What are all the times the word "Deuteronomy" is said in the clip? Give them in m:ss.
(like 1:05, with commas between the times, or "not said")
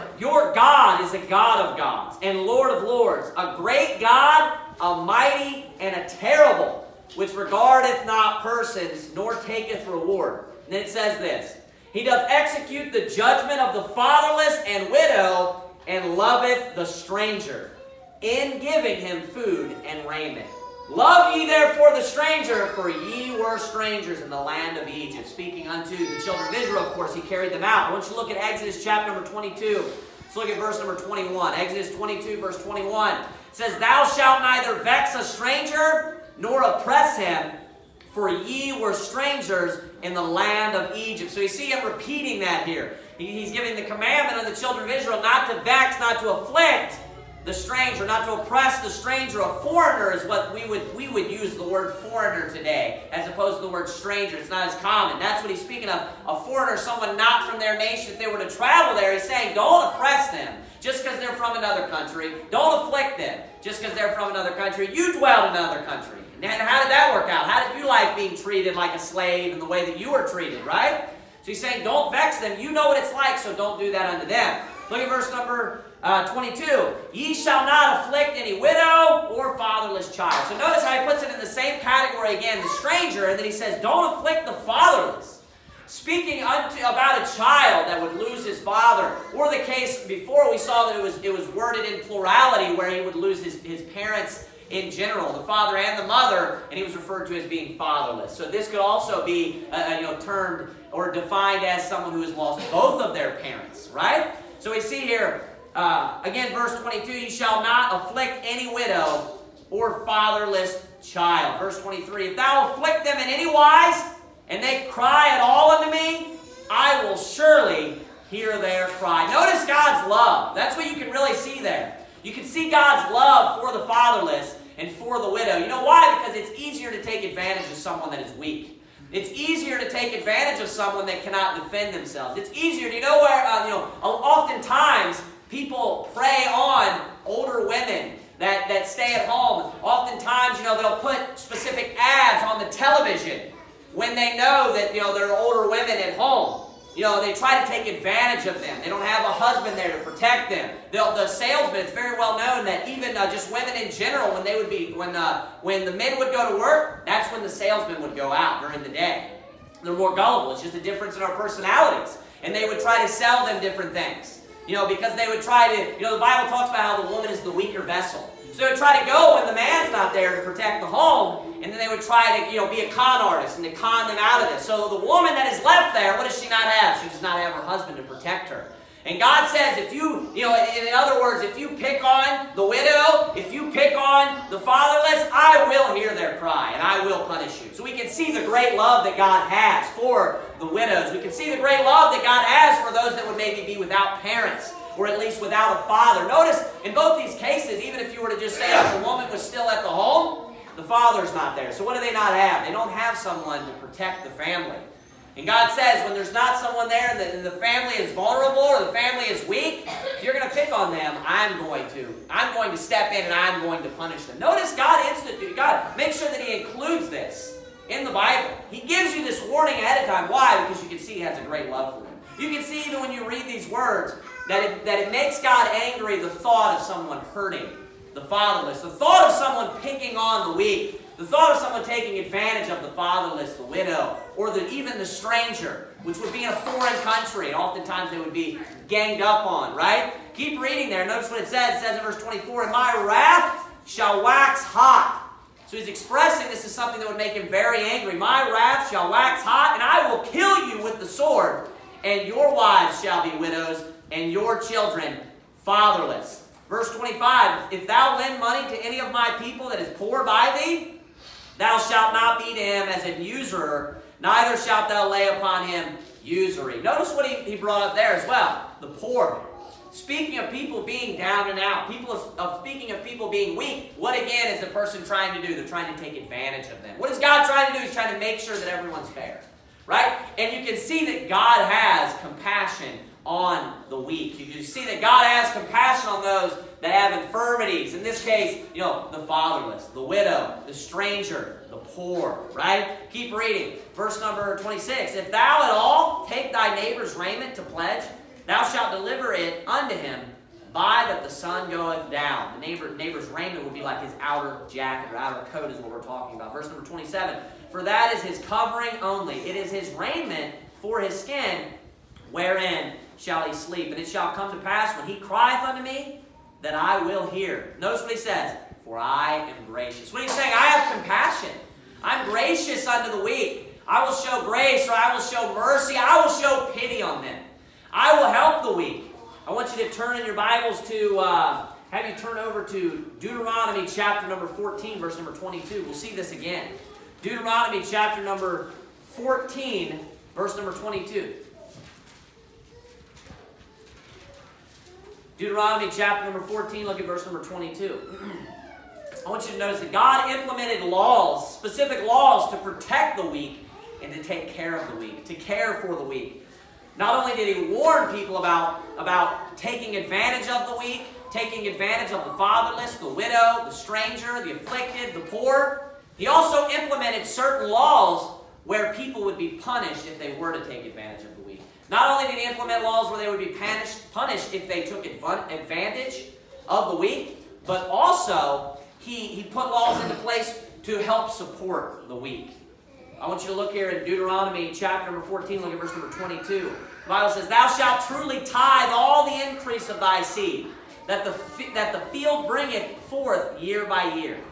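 5:33, 5:37, 5:45, 6:24.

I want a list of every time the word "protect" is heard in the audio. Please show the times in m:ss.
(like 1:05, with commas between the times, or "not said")
2:30, 2:50, 2:58, 3:23, 5:52.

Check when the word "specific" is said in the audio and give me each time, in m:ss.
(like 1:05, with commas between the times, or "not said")
2:21, 5:51.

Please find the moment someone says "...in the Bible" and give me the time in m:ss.
3:37.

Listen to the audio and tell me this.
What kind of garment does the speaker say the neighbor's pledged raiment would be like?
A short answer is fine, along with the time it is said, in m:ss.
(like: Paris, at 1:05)
outer coat, at 5:05.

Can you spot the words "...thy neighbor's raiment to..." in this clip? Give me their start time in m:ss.
4:56.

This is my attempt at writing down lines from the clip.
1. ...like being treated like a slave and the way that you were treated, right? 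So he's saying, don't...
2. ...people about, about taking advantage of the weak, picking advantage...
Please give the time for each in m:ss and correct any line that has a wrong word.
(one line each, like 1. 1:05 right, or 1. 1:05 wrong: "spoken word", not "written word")
1. 1:07 right
2. 5:58 wrong: "taking", not "picking".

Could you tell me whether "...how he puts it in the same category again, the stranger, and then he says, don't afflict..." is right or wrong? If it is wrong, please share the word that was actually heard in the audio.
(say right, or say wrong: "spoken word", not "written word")
right.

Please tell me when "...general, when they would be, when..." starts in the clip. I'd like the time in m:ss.
2:33.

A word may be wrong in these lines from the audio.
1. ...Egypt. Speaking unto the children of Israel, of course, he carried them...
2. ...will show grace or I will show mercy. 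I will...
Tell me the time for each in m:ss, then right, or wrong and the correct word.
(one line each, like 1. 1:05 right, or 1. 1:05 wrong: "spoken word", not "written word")
1. 0:24 right
2. 5:24 right.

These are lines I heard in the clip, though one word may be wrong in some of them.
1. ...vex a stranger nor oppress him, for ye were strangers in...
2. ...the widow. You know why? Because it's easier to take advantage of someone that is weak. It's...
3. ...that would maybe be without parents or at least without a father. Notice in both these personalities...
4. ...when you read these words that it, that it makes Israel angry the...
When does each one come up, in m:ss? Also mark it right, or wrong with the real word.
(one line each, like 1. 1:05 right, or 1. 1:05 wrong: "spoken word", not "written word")
1. 0:34 right
2. 2:05 right
3. 3:13 wrong: "cases", not "personalities"
4. 3:42 wrong: "God", not "Israel".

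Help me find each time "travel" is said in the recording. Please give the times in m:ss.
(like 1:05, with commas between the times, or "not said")
0:58.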